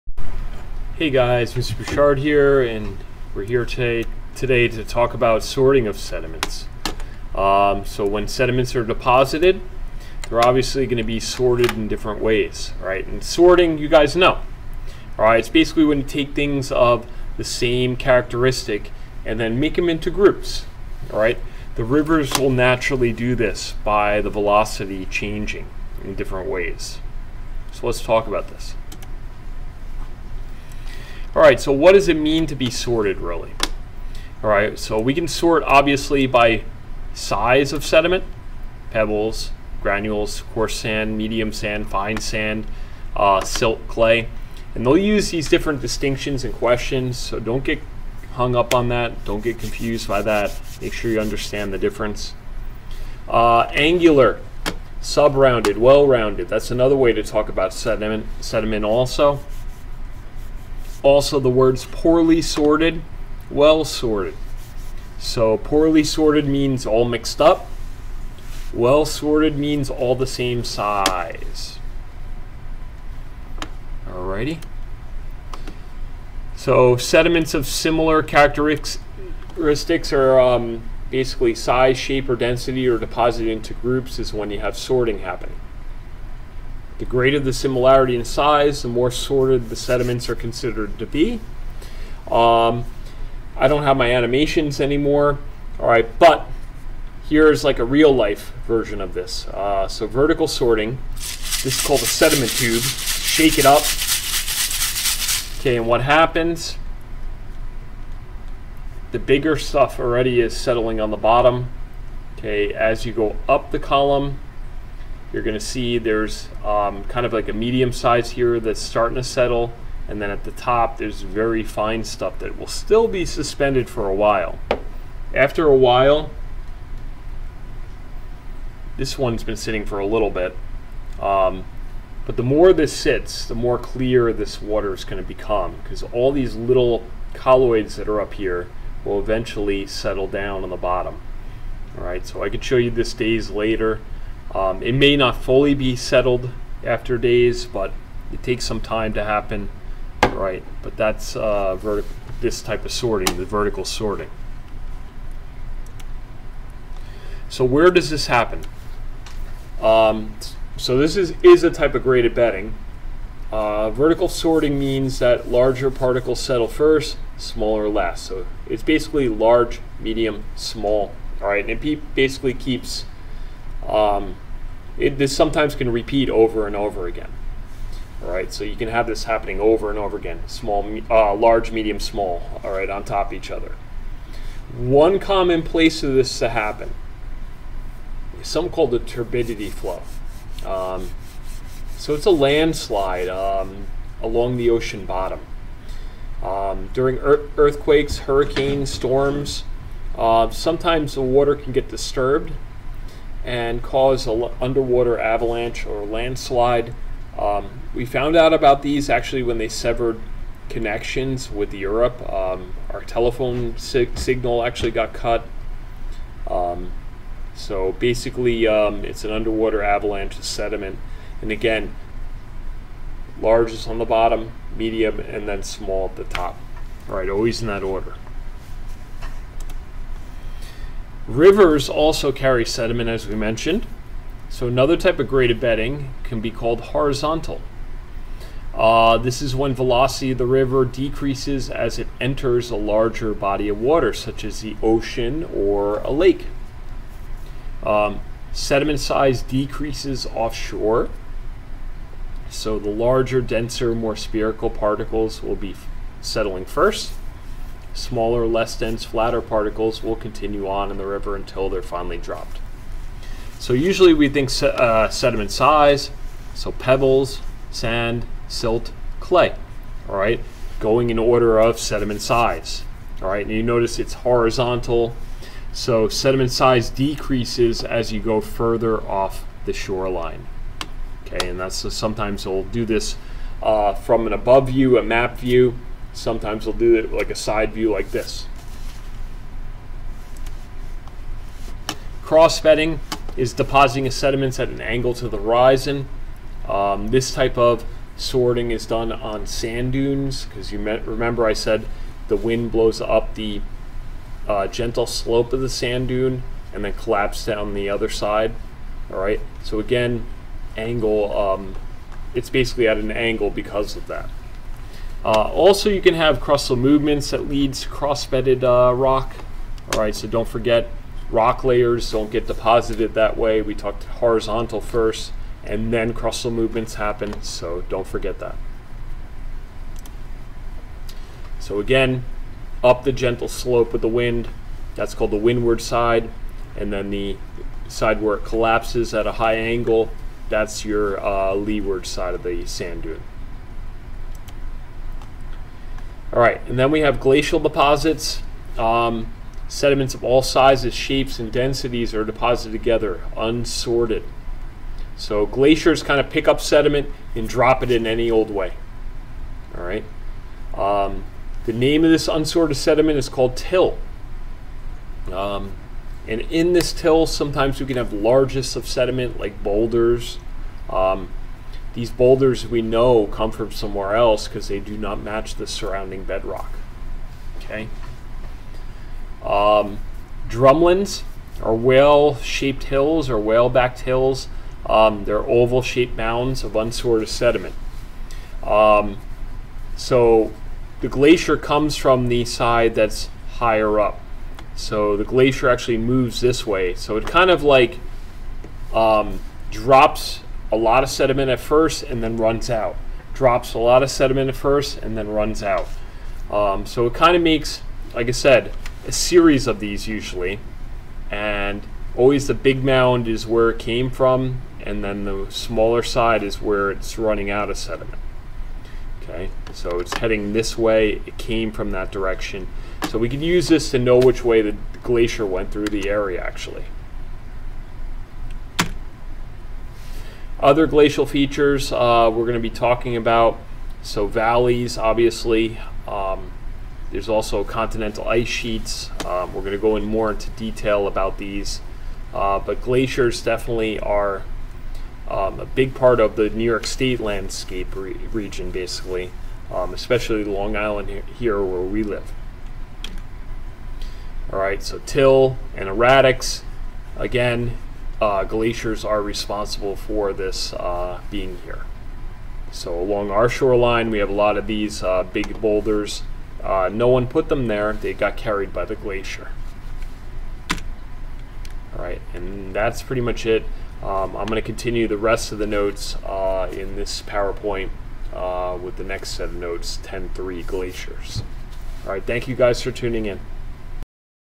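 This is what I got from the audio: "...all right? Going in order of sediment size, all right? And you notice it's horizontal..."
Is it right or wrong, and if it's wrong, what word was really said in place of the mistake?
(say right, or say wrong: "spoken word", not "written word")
right.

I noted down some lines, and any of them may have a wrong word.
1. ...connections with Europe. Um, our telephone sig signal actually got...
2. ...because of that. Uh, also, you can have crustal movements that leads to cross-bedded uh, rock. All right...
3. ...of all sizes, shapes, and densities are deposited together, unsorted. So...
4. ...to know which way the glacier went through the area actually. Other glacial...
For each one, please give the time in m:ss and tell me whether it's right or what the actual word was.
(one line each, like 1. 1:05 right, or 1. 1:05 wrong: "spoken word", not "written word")
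1. 3:30 right
2. 5:13 right
3. 5:50 right
4. 7:03 right.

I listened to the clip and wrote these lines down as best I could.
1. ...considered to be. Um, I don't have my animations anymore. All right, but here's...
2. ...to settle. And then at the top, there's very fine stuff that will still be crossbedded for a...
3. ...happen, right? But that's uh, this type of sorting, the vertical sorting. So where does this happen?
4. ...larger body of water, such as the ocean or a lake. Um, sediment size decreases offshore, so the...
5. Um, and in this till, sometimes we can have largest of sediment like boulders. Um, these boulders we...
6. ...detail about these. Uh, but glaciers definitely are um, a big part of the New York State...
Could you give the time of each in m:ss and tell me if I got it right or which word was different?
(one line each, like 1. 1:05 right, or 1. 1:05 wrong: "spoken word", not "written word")
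1. 1:30 right
2. 1:59 wrong: "suspended", not "crossbedded"
3. 2:29 right
4. 4:02 right
5. 6:05 right
6. 7:20 right.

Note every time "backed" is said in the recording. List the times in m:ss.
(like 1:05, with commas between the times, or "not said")
6:23.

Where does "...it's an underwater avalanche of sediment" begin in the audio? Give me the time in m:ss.
3:39.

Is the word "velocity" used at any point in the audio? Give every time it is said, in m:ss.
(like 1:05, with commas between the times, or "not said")
0:24, 3:59.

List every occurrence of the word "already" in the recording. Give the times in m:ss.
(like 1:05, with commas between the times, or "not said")
1:49.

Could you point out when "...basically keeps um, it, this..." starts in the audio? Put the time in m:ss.
2:52.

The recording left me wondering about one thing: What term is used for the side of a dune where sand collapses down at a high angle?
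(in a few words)
leeward side.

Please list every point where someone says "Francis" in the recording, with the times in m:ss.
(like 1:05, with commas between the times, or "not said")
not said.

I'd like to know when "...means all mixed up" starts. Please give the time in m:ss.
1:06.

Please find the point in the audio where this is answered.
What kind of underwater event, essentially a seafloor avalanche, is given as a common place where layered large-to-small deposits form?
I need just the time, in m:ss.
3:08.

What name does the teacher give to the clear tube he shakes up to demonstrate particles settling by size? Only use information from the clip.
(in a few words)
sediment tube.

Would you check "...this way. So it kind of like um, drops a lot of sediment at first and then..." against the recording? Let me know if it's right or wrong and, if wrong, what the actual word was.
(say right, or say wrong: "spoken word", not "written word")
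right.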